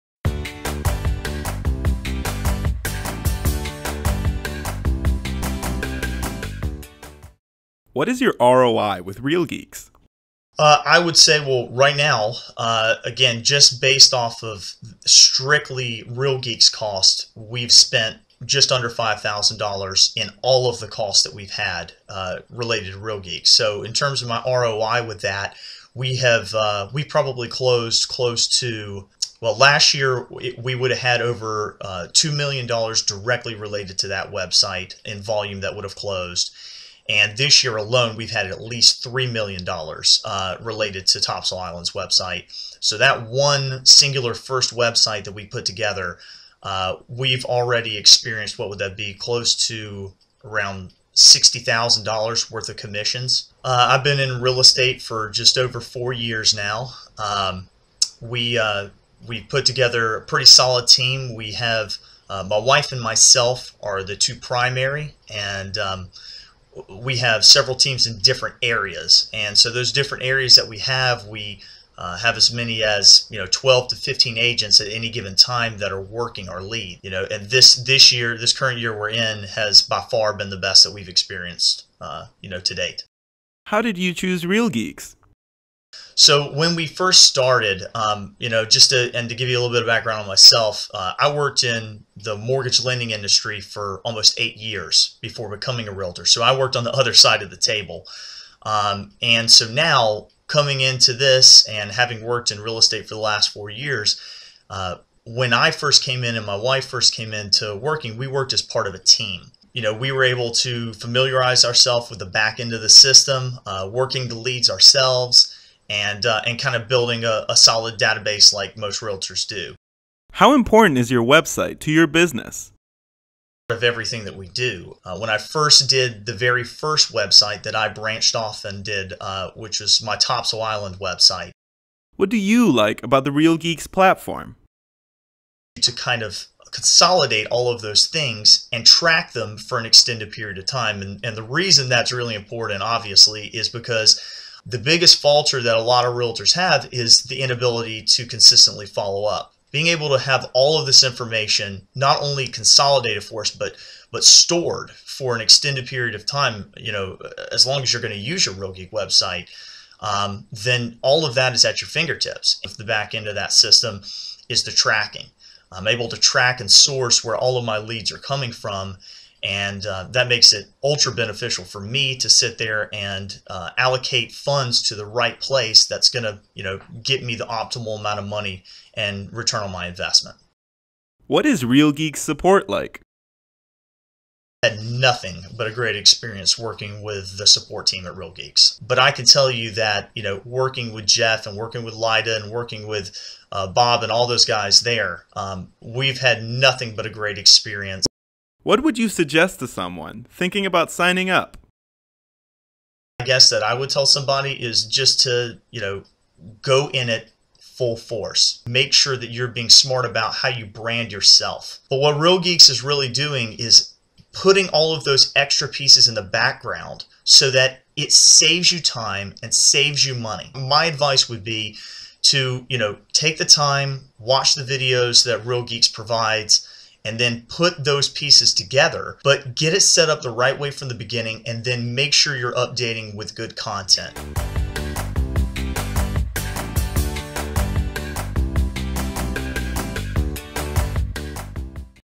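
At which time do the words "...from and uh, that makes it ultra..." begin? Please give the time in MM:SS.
02:48.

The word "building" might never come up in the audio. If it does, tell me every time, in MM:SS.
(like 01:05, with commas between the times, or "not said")
01:56.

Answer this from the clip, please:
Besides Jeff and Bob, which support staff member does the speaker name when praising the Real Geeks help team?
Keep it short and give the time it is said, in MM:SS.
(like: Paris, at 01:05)
Lida, at 03:11.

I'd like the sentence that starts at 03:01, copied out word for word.
What is Real Geek support like?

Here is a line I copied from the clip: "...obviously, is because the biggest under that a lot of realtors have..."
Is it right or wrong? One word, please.
wrong.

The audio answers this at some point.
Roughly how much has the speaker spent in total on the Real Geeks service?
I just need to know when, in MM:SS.
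00:18.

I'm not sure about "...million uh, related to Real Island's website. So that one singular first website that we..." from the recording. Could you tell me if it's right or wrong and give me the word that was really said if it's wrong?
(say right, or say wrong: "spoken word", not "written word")
wrong: "Topsail", not "Real".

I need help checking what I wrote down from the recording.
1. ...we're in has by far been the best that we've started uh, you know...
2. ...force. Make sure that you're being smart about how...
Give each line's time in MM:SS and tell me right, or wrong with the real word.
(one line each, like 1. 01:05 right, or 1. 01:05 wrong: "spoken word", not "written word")
1. 01:18 wrong: "experienced", not "started"
2. 03:27 right.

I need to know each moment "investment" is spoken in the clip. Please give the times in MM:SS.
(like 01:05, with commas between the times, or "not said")
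02:59.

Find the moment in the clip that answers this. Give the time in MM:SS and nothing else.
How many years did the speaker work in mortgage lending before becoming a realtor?
01:34.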